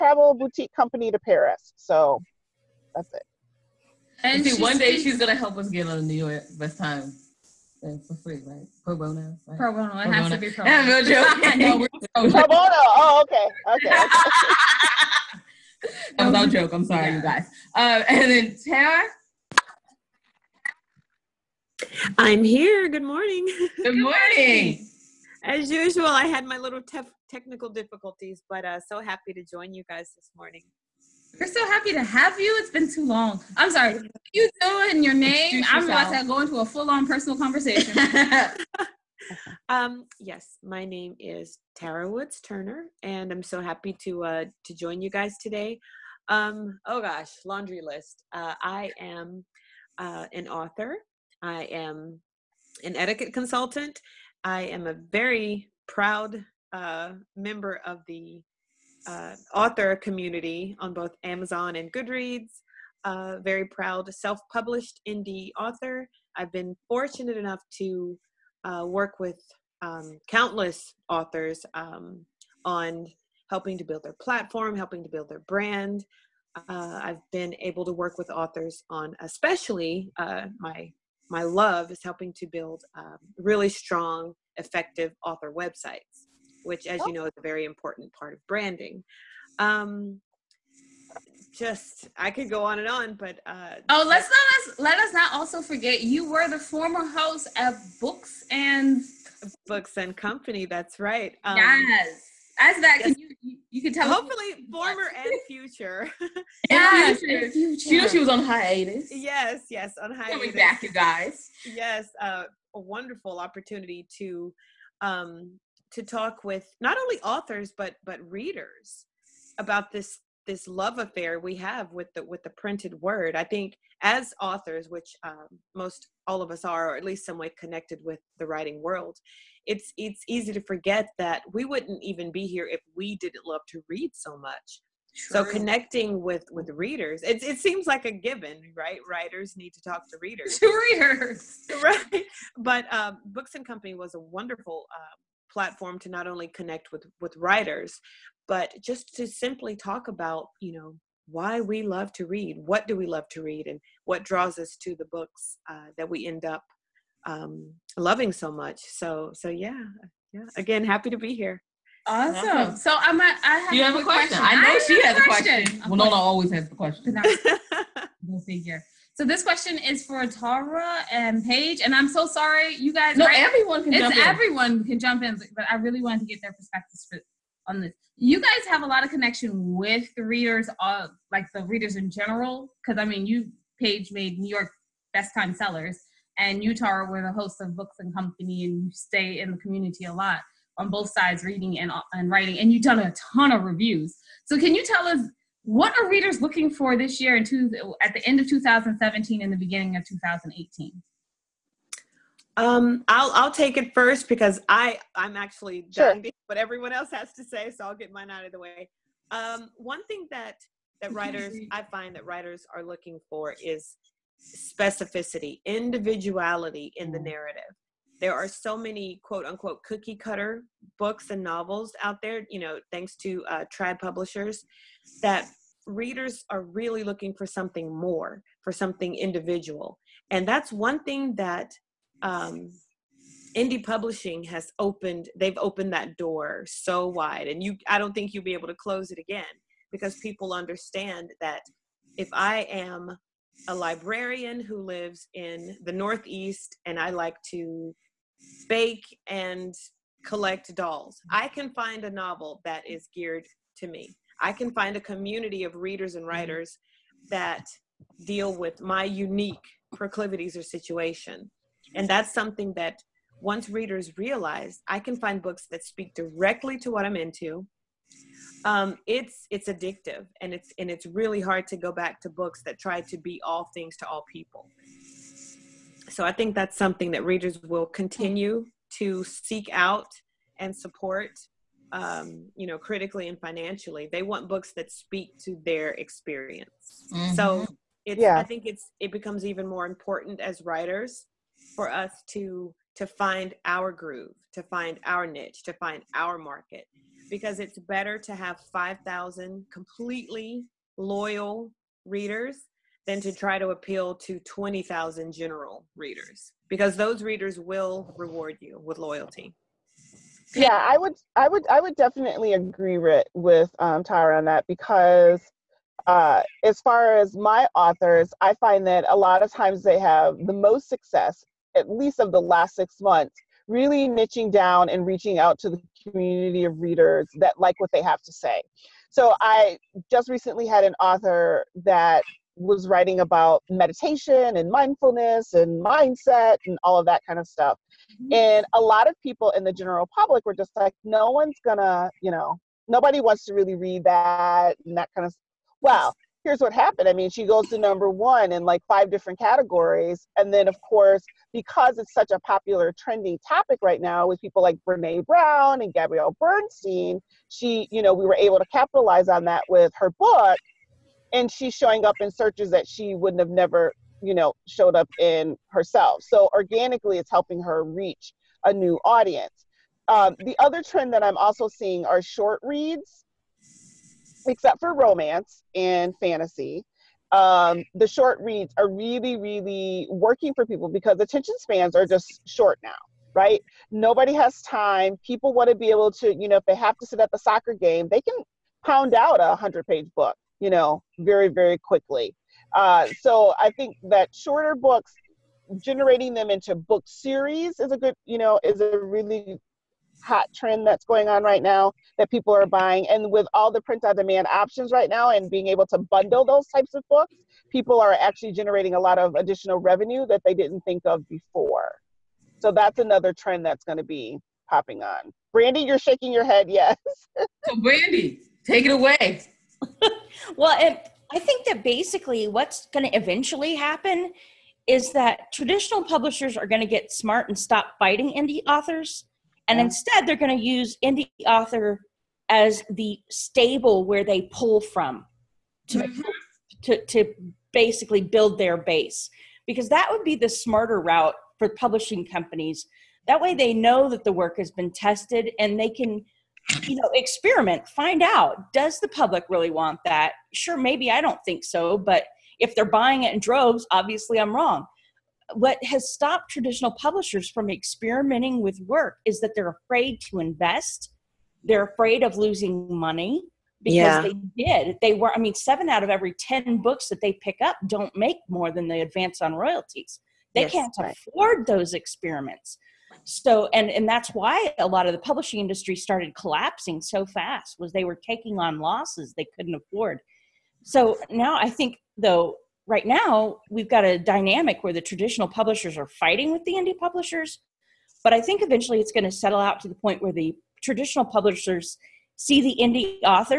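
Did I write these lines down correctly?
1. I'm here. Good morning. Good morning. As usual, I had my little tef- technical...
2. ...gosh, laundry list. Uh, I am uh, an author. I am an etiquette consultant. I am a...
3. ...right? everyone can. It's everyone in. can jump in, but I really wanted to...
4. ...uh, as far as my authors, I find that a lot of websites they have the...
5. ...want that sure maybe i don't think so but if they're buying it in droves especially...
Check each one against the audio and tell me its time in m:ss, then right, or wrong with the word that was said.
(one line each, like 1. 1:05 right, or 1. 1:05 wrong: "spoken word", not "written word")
1. 0:22 right
2. 0:47 right
3. 2:53 right
4. 5:16 wrong: "times", not "websites"
5. 7:29 wrong: "obviously", not "especially".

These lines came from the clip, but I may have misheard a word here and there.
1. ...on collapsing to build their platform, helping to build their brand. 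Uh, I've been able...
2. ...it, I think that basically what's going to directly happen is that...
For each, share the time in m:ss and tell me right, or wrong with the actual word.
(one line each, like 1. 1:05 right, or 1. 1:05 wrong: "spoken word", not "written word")
1. 1:12 wrong: "helping", not "collapsing"
2. 7:00 wrong: "eventually", not "directly".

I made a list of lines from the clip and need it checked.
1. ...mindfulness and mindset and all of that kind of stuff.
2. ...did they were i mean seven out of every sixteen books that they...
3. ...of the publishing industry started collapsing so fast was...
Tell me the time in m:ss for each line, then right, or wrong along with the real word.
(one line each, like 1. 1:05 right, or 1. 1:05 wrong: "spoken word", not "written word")
1. 5:34 right
2. 7:44 wrong: "ten", not "sixteen"
3. 7:55 right.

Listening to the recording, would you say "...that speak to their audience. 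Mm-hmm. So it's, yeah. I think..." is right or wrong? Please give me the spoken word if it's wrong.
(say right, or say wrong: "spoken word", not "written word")
wrong: "experience", not "audience".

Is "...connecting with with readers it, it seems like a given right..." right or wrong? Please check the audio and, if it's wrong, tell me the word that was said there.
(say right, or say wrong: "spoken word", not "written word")
right.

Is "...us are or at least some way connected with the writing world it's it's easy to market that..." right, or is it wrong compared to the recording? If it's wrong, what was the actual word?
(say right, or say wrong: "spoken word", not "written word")
wrong: "forget", not "market".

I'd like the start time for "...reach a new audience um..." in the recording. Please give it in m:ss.
6:07.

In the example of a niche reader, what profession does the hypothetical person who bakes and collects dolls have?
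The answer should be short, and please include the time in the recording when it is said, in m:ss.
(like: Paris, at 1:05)
Librarian, at 4:03.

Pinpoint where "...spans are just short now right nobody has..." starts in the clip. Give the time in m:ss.
6:21.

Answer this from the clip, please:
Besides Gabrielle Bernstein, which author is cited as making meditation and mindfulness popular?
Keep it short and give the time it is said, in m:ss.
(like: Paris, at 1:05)
Brene Brown, at 5:54.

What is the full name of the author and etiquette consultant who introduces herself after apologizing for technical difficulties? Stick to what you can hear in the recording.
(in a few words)
Tara Woods Turner.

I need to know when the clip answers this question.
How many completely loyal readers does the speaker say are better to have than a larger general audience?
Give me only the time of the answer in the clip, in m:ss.
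4:58.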